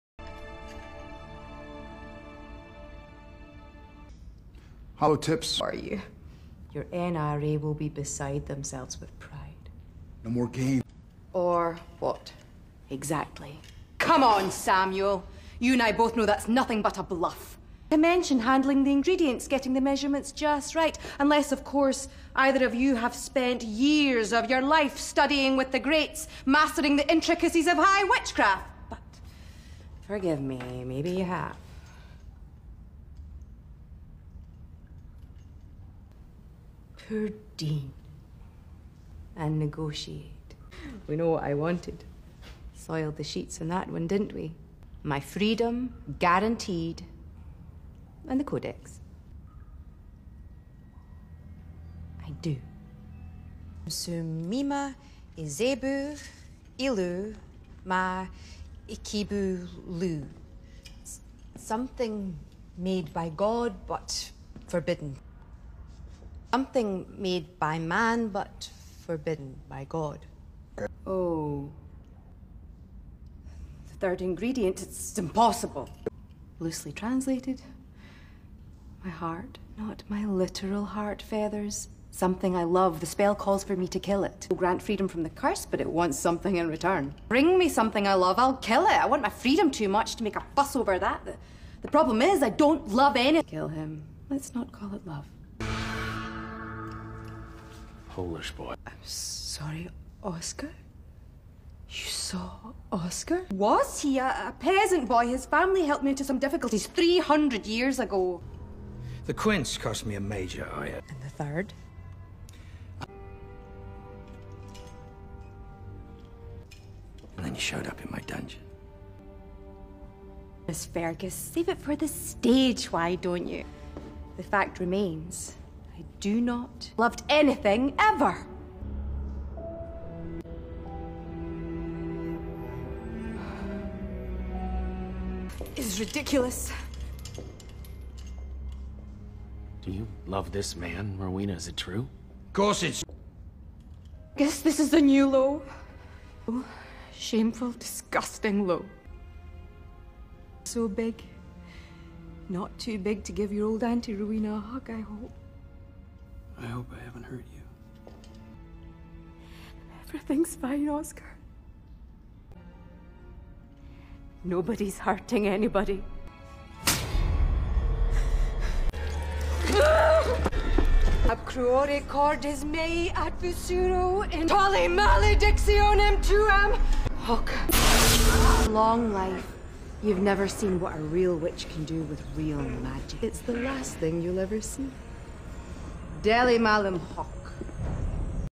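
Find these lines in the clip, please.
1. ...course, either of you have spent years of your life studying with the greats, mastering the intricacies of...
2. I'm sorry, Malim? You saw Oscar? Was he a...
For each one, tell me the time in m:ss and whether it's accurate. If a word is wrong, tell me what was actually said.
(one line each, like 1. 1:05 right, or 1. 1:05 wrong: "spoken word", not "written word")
1. 0:21 right
2. 1:38 wrong: "Oscar", not "Malim".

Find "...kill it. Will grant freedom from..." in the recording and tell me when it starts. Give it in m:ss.
1:23.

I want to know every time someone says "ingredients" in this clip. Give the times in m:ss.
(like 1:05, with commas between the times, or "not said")
0:18, 1:14.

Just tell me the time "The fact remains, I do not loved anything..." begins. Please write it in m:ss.
2:04.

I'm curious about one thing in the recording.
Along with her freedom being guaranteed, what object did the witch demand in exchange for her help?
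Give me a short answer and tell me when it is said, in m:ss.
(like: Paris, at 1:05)
The Codex, at 0:48.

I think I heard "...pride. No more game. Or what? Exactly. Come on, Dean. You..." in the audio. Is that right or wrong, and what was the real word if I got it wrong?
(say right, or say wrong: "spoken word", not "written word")
wrong: "Samuel", not "Dean".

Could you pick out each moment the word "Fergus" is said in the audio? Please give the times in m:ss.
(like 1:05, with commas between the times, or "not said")
2:00.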